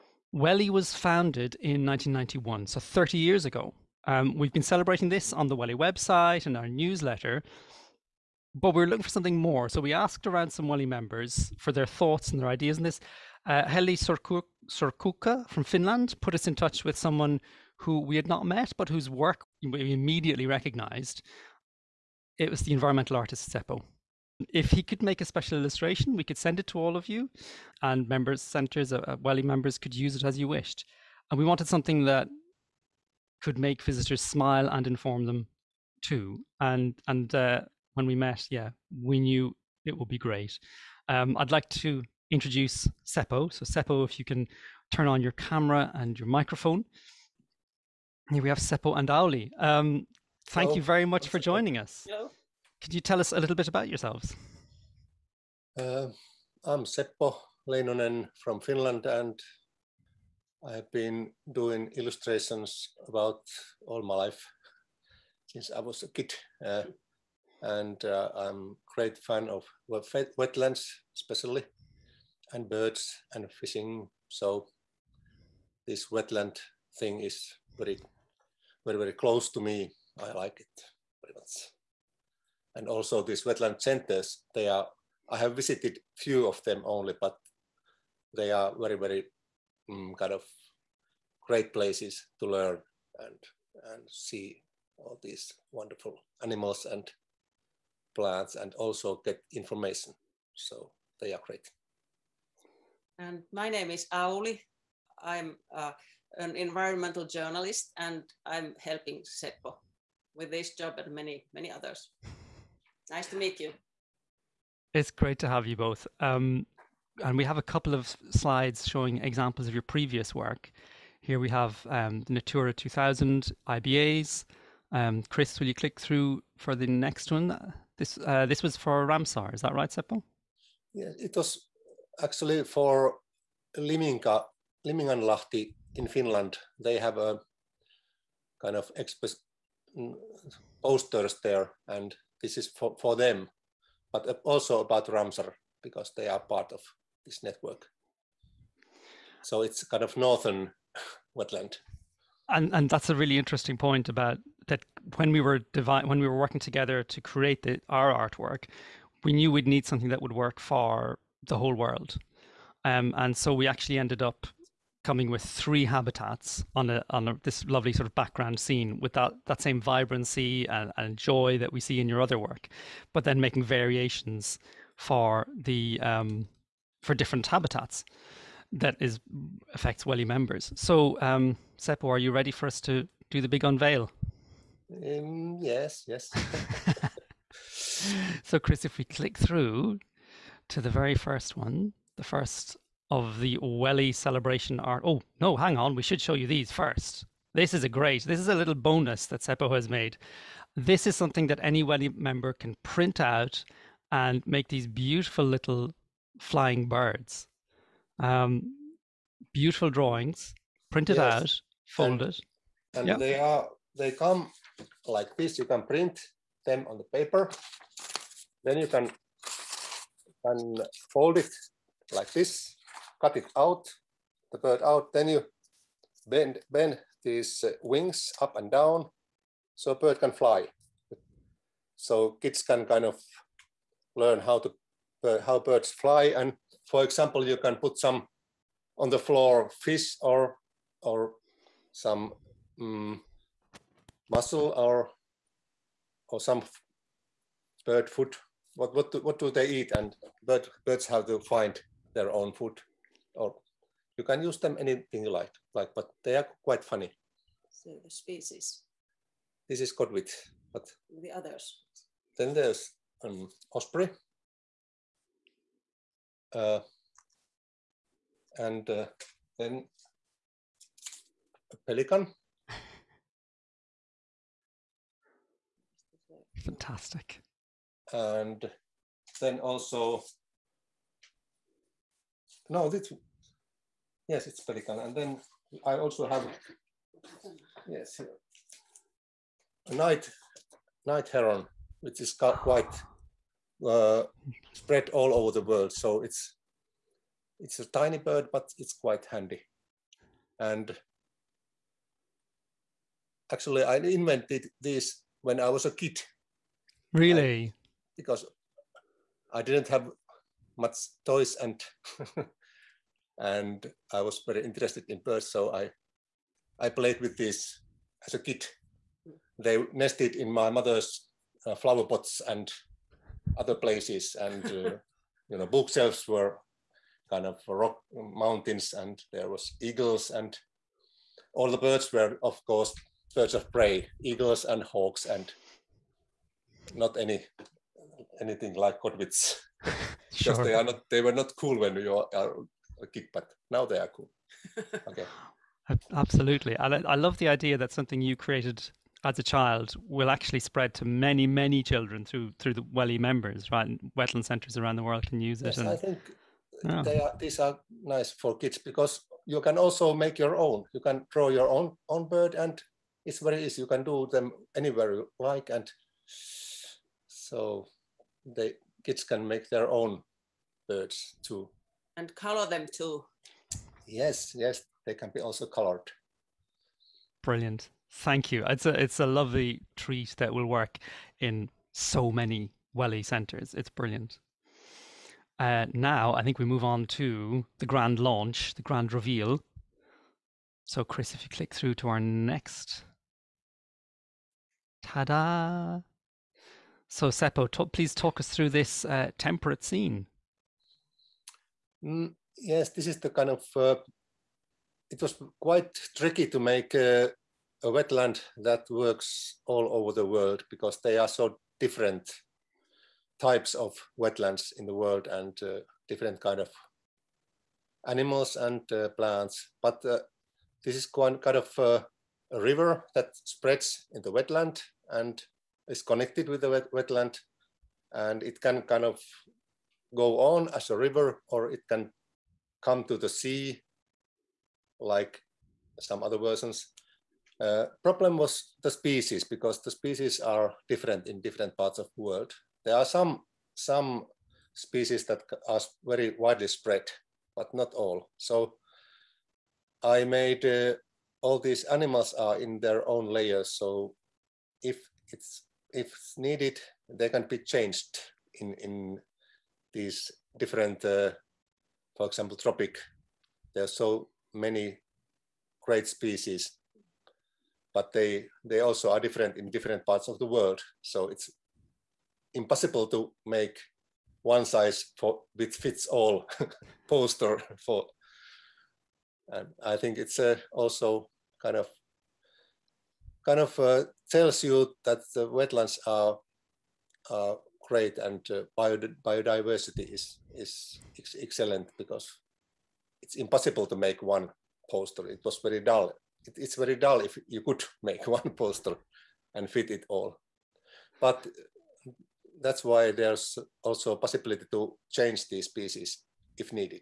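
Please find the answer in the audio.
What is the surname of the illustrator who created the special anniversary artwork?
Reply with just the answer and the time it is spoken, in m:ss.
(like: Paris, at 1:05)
Leinonen, at 0:57.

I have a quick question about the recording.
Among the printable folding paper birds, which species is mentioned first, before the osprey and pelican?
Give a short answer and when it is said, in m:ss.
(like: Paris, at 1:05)
Godwit, at 4:19.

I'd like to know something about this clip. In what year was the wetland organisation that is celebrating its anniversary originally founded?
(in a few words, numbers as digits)
1991.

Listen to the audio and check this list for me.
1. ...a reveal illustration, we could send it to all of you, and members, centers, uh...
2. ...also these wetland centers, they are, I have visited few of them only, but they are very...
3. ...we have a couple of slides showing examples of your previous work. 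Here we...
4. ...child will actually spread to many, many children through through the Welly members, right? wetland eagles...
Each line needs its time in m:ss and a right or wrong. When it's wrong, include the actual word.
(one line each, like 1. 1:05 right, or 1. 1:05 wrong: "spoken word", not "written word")
1. 0:25 wrong: "special", not "reveal"
2. 1:22 right
3. 1:57 right
4. 5:49 wrong: "centres", not "eagles".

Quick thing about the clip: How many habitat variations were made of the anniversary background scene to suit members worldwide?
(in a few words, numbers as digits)
3.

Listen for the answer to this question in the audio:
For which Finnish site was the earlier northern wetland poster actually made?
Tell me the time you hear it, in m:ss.
2:14.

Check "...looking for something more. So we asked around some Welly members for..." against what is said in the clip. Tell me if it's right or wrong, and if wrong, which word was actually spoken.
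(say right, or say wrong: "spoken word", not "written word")
right.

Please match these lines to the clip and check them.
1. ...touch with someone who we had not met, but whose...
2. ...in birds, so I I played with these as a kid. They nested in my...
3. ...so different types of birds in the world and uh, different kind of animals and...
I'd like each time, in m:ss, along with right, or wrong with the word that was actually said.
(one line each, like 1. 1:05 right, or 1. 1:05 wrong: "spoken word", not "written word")
1. 0:16 right
2. 5:15 right
3. 6:51 wrong: "wetlands", not "birds".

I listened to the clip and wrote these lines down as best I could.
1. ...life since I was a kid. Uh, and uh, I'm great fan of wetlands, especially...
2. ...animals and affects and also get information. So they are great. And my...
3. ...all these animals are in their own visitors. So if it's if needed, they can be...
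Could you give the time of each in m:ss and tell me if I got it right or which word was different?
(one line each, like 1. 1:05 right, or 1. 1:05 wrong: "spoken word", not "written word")
1. 1:04 right
2. 1:36 wrong: "plants", not "affects"
3. 7:31 wrong: "layers", not "visitors".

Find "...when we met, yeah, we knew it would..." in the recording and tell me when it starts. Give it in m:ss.
0:37.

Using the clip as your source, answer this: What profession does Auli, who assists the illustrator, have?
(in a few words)
Environmental journalist.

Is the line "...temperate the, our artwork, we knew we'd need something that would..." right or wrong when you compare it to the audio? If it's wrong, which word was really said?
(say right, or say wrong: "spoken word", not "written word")
wrong: "create", not "temperate".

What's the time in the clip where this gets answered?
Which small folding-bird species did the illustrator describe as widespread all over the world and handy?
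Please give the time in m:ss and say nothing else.
4:51.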